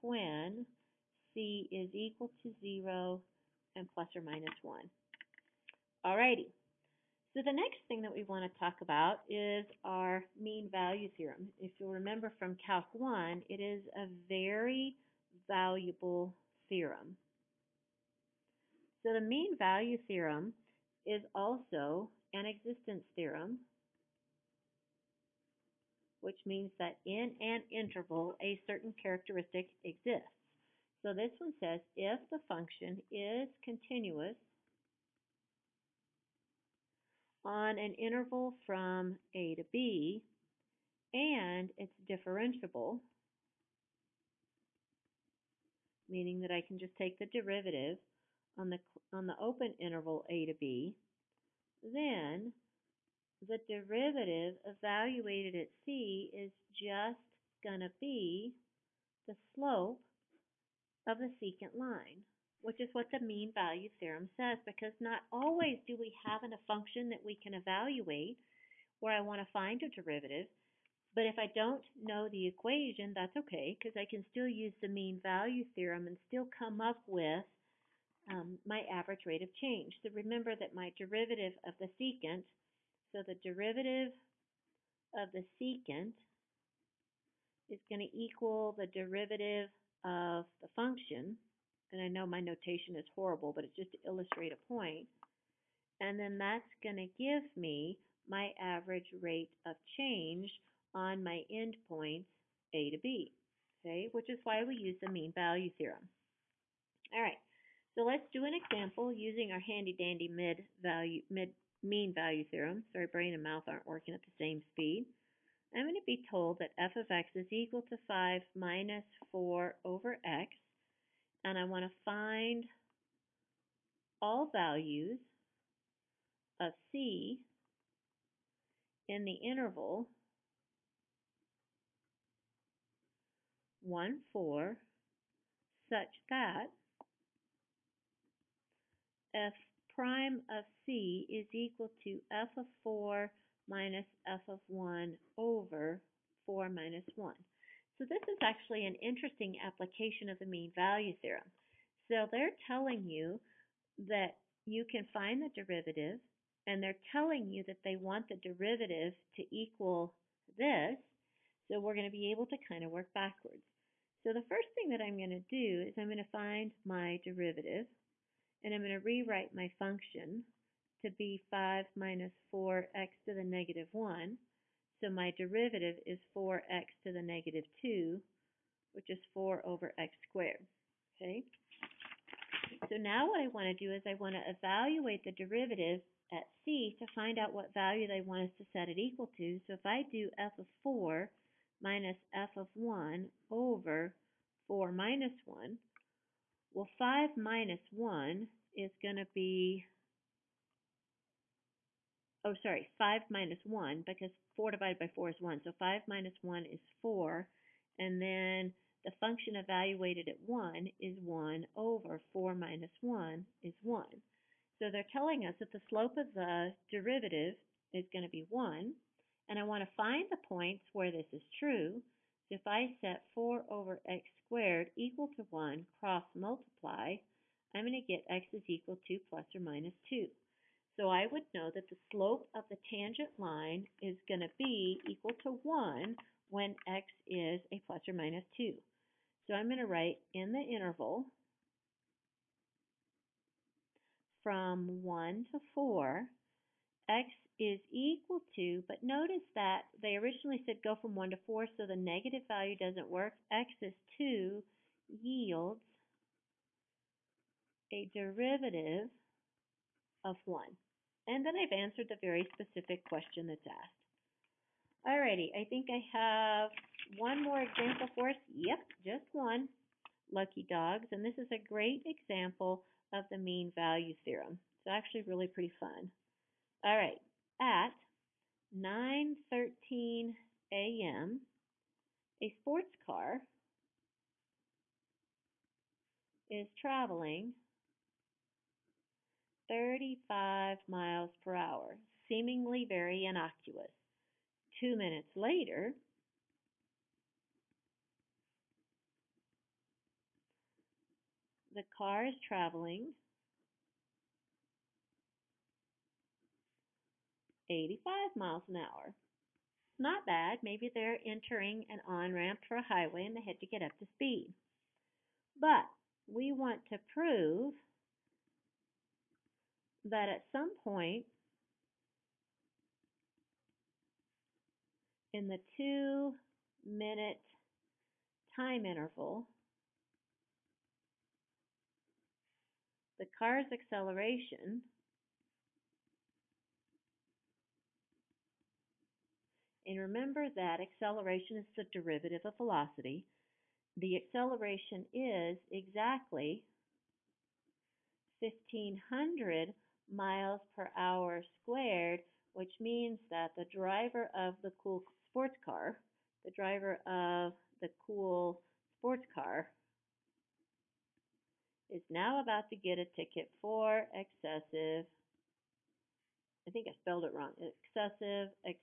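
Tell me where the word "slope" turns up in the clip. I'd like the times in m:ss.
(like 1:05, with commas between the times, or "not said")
0:59, 3:35, 3:52.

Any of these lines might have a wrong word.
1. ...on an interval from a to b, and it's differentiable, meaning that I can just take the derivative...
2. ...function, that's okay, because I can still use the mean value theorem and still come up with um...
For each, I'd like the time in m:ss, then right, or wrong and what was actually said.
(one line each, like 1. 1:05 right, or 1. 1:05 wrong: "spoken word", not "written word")
1. 0:37 right
2. 1:12 wrong: "equation", not "function".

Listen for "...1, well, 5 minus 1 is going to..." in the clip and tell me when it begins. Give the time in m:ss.
3:15.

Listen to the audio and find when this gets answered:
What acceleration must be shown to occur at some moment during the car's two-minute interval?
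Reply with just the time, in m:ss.
5:48.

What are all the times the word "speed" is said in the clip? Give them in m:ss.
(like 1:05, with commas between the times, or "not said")
1:54, 5:14.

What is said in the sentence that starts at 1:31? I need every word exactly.
And I know my notation is horrible, but it's just to illustrate a point.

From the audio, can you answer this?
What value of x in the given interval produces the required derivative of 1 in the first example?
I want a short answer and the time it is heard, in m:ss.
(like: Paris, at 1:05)
2, at 4:13.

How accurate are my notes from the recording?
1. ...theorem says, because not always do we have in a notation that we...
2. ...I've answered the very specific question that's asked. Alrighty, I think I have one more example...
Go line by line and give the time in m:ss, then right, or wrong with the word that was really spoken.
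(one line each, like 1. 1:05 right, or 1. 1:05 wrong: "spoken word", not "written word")
1. 1:03 wrong: "function", not "notation"
2. 4:21 right.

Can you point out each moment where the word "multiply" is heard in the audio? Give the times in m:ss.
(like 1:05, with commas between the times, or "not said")
3:46.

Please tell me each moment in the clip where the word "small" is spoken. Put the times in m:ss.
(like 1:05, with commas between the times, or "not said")
not said.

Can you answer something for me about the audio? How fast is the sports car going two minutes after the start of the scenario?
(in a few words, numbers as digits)
85 mph.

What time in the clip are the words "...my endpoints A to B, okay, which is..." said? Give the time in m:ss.
1:41.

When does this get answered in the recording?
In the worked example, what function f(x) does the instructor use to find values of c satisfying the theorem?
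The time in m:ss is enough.
1:58.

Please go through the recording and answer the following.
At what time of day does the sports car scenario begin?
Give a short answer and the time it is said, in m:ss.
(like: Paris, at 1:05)
9:13 a.m., at 4:38.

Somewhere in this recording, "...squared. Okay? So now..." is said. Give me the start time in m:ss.
3:00.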